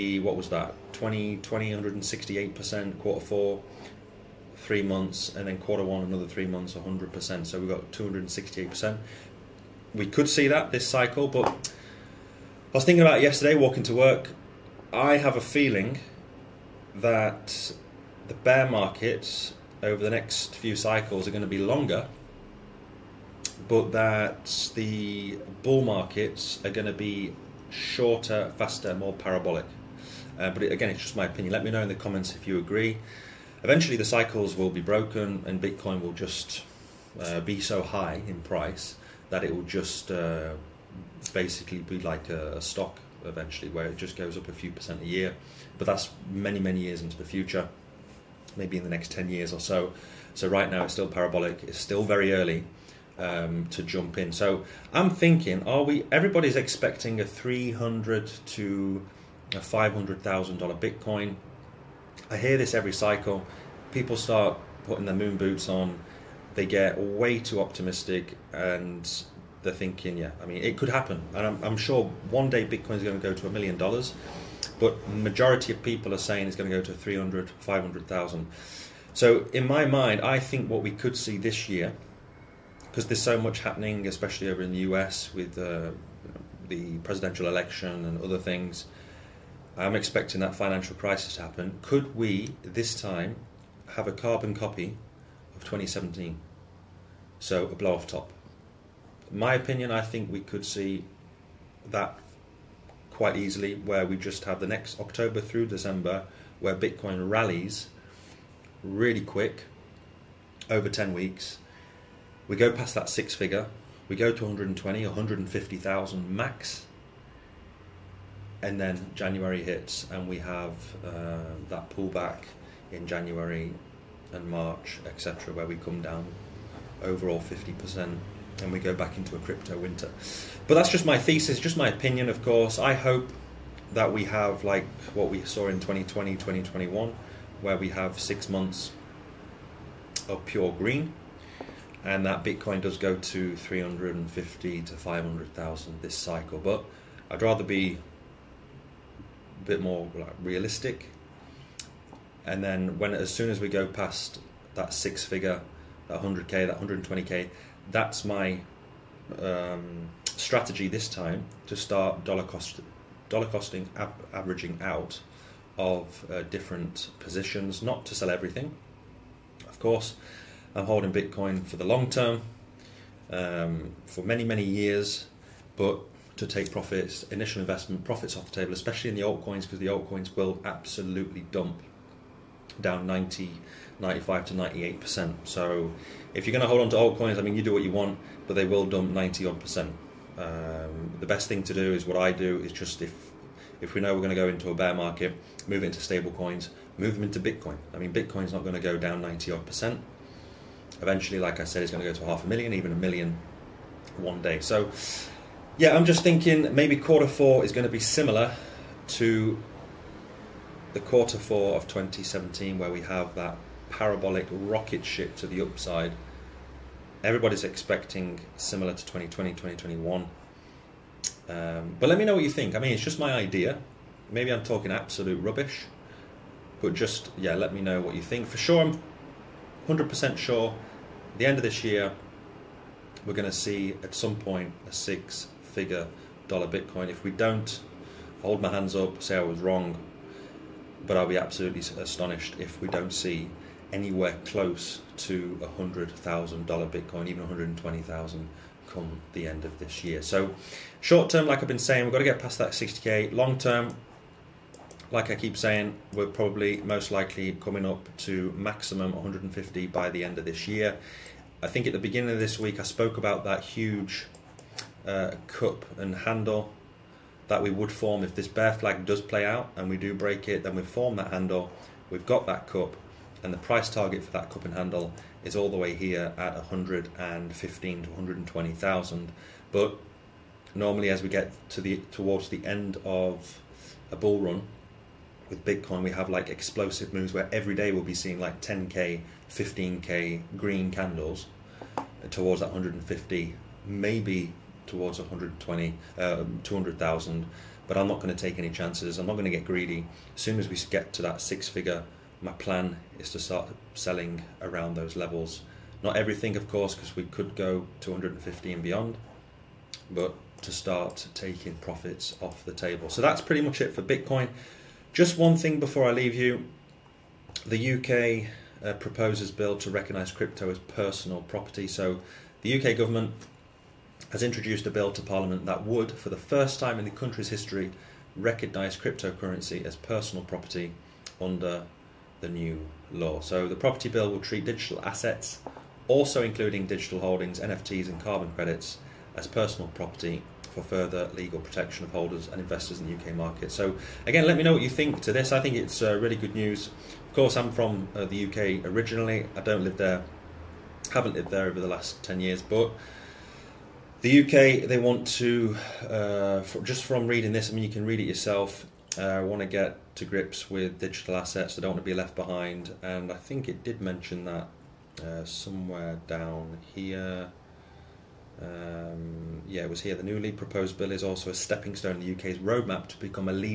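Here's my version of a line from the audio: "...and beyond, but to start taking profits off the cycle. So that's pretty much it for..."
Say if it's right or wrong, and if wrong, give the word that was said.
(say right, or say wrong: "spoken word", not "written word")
wrong: "table", not "cycle".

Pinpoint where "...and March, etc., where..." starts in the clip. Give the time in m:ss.
2:04.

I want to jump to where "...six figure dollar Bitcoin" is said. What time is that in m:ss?
3:54.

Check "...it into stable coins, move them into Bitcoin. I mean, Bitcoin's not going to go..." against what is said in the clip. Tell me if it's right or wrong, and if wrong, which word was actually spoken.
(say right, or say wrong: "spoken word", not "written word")
right.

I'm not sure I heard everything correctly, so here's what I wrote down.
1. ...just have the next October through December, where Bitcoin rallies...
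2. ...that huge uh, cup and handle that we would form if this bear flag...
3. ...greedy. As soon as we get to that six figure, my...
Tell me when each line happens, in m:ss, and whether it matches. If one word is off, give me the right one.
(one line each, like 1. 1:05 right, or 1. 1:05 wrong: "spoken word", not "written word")
1. 1:44 right
2. 4:23 right
3. 4:59 right.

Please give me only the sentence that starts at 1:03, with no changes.
People start putting their moon boots on.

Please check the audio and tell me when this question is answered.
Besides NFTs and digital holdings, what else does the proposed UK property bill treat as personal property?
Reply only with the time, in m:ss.
5:38.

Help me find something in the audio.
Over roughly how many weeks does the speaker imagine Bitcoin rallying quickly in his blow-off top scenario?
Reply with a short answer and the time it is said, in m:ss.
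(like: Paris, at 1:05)
10 weeks, at 1:50.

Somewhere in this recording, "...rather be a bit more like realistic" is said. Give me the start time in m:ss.
2:27.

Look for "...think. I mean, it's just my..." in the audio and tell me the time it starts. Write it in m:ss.
3:42.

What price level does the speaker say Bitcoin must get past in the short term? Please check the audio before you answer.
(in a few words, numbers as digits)
60K.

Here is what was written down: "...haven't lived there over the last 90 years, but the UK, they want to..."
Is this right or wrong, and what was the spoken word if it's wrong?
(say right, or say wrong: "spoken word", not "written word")
wrong: "10", not "90".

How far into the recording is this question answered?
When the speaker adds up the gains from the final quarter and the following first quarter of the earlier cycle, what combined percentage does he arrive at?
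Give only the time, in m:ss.
0:07.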